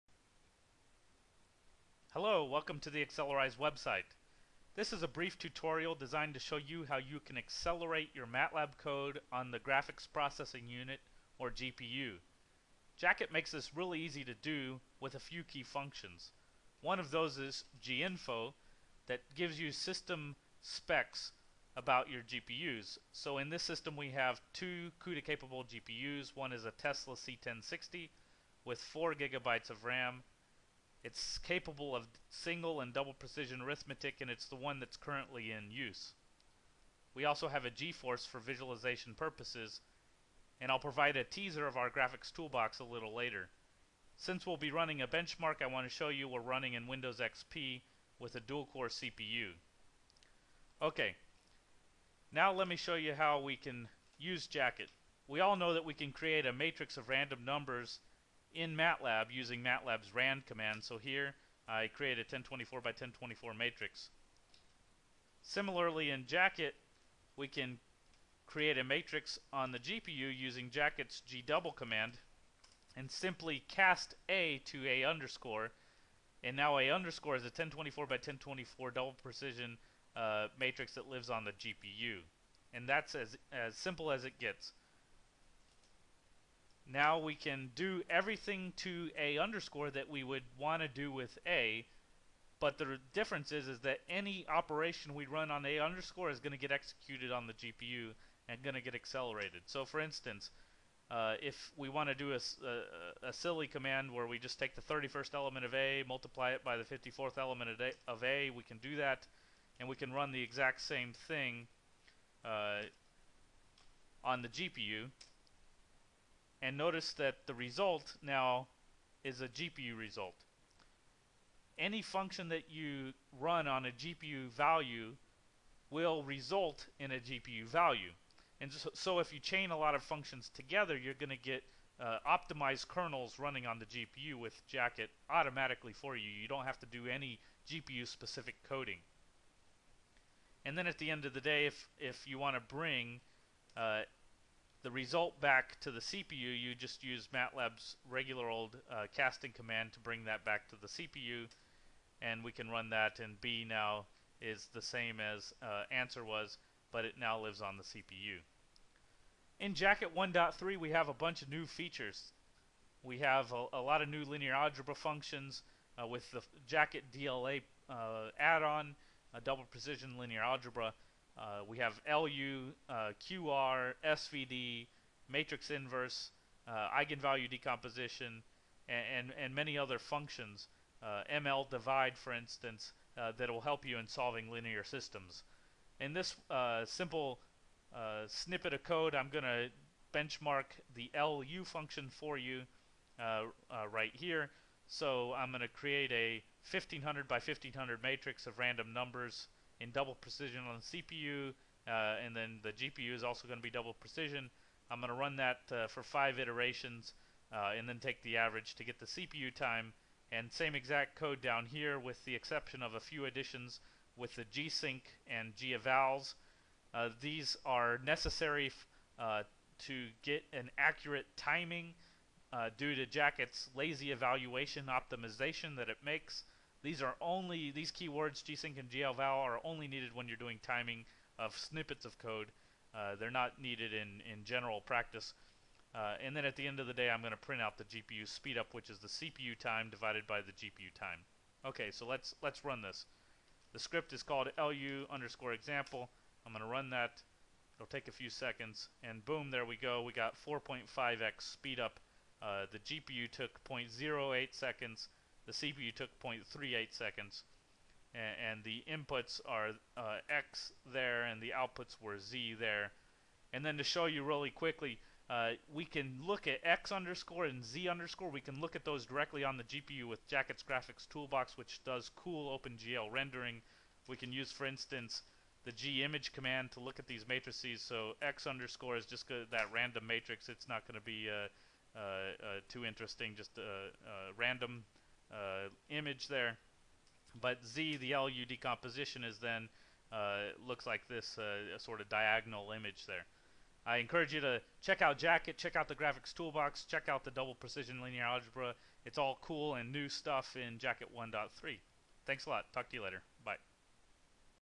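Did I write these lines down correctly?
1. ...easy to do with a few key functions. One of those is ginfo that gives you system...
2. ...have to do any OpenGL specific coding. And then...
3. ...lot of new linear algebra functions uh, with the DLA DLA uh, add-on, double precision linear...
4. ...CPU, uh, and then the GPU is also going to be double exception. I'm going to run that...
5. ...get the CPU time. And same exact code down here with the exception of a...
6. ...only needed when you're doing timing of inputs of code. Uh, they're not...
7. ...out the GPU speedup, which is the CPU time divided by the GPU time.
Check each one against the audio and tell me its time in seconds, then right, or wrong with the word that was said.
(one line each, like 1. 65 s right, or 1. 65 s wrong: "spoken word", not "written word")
1. 14 s right
2. 136 s wrong: "GPU", not "OpenGL"
3. 163 s wrong: "Jacket", not "DLA"
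4. 201 s wrong: "precision", not "exception"
5. 208 s right
6. 229 s wrong: "snippets", not "inputs"
7. 237 s right.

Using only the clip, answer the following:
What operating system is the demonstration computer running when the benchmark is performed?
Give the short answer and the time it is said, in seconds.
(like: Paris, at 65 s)
Windows XP, at 46 s.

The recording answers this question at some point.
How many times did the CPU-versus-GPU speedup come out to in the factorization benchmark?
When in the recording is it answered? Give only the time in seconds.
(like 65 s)
250 s.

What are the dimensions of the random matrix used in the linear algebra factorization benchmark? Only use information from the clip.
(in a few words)
1500 by 1500.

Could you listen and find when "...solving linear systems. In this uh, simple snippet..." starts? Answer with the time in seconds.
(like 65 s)
184 s.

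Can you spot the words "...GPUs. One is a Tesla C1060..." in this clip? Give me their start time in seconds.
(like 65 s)
25 s.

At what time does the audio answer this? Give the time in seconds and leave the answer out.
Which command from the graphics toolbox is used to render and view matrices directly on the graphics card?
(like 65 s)
275 s.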